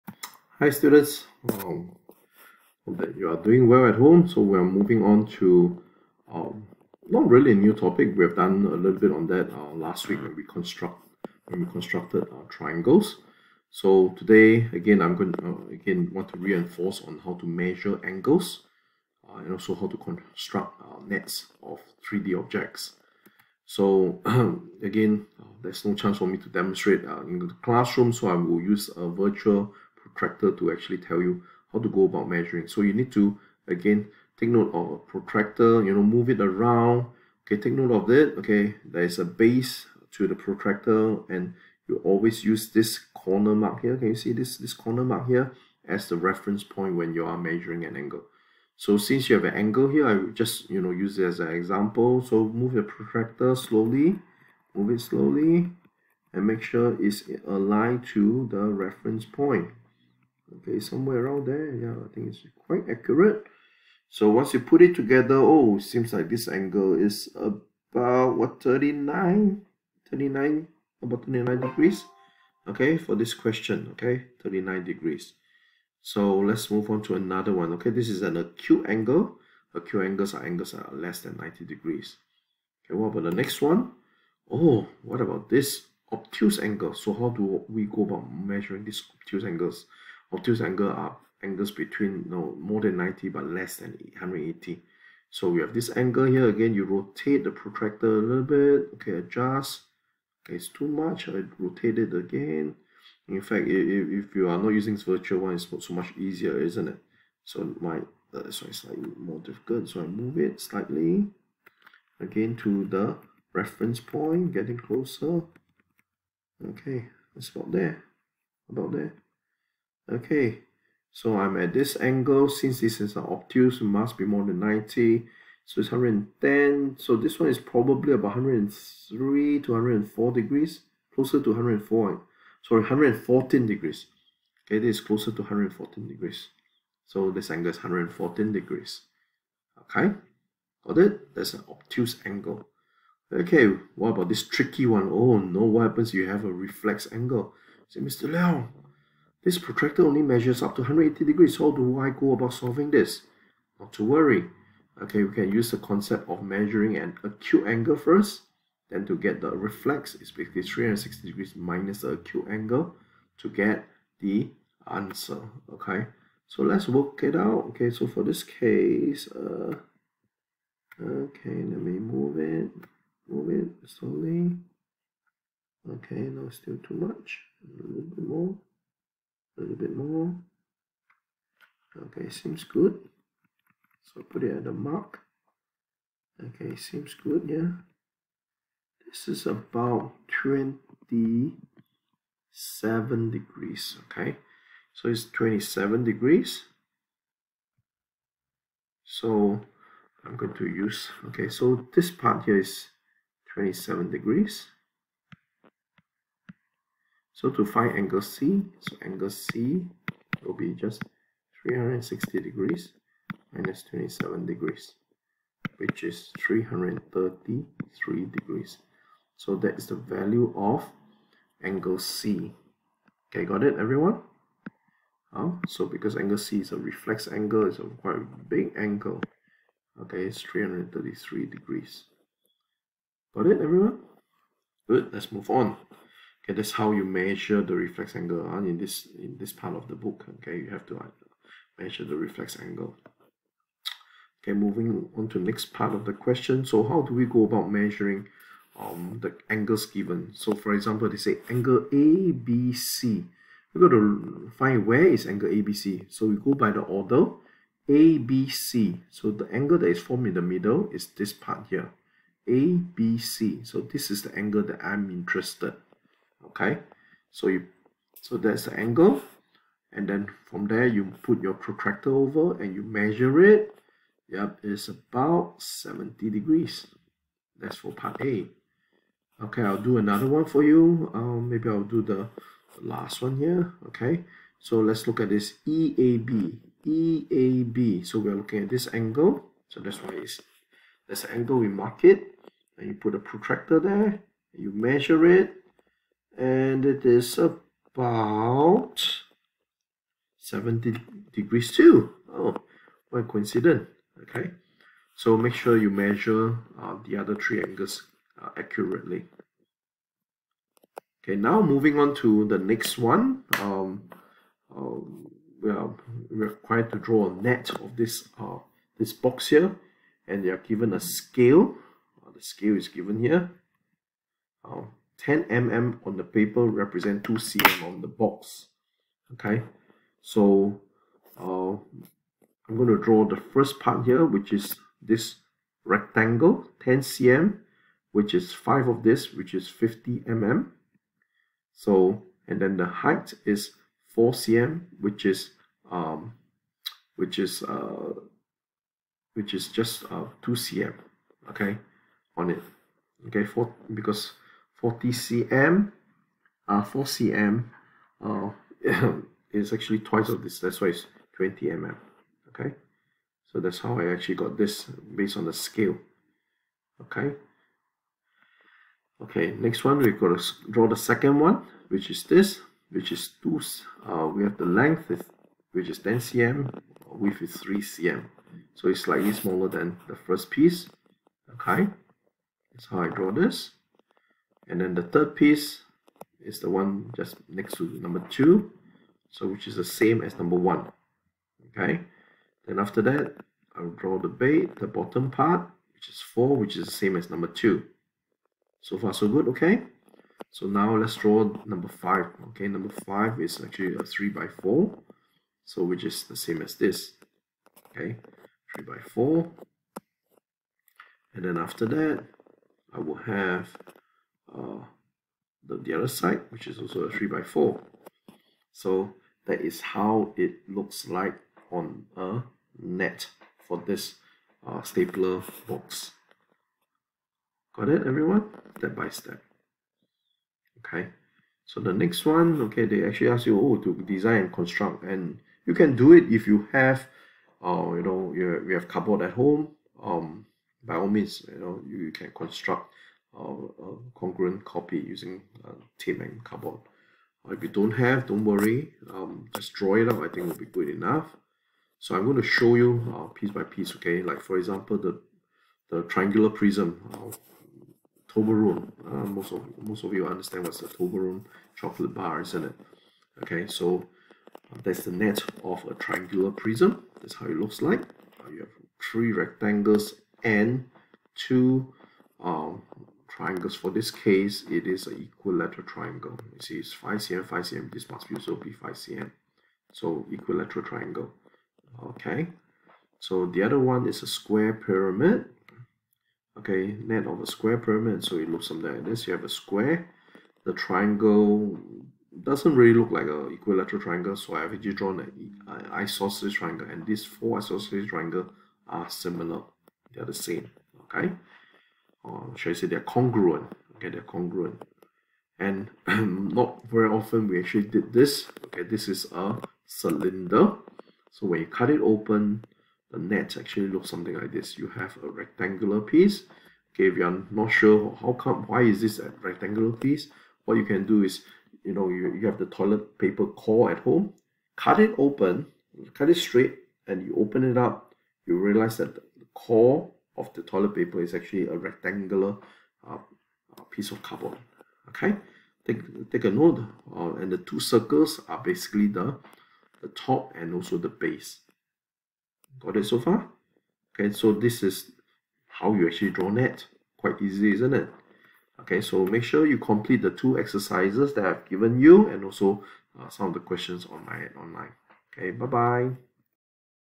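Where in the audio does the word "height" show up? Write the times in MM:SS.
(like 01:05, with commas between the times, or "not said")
05:42.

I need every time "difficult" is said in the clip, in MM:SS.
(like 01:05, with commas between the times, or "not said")
01:49.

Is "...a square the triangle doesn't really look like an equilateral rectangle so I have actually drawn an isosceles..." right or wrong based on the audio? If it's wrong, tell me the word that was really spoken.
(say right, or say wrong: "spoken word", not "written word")
wrong: "triangle", not "rectangle".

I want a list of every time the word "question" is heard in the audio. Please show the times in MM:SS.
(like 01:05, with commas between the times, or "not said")
01:13, 04:06, 09:13.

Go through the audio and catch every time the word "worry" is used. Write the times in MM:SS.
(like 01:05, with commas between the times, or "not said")
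02:34, 07:28.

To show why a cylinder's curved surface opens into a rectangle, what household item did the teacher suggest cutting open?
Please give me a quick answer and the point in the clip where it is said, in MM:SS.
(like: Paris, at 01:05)
toilet paper core, at 08:42.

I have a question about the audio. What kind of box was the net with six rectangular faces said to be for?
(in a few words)
stapler box.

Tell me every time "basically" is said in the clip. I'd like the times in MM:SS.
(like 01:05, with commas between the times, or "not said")
02:40, 08:58.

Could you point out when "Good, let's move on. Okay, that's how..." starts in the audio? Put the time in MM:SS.
03:54.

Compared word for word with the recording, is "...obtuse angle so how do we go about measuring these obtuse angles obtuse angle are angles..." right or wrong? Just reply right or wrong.
right.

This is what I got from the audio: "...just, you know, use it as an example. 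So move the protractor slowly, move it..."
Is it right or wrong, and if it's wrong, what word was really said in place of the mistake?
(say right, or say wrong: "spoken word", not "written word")
right.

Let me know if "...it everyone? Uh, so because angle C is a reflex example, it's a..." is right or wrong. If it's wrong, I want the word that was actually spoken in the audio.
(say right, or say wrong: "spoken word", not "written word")
wrong: "angle", not "example".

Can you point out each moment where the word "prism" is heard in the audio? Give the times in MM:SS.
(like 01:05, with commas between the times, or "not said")
07:36, 07:46.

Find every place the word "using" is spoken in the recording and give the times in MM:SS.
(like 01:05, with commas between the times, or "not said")
01:44, 07:24.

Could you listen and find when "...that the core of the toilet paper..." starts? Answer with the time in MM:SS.
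08:48.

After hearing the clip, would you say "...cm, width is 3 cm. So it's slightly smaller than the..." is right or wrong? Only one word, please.
right.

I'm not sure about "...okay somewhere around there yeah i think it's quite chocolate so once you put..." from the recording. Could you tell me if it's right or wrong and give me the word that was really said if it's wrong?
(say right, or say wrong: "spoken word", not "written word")
wrong: "accurate", not "chocolate".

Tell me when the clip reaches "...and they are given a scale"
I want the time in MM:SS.
05:20.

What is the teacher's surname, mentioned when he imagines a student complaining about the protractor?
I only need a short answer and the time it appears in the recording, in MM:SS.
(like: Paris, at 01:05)
Leong, at 02:28.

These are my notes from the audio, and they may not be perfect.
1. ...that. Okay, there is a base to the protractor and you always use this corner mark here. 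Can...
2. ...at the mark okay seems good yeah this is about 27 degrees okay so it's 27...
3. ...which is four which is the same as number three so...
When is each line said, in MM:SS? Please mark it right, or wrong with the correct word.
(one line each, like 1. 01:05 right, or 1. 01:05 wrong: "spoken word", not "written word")
1. 00:38 right
2. 03:04 right
3. 06:35 wrong: "two", not "three".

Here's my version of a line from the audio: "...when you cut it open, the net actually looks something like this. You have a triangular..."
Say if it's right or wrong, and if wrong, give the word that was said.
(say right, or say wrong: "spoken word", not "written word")
wrong: "rectangular", not "triangular".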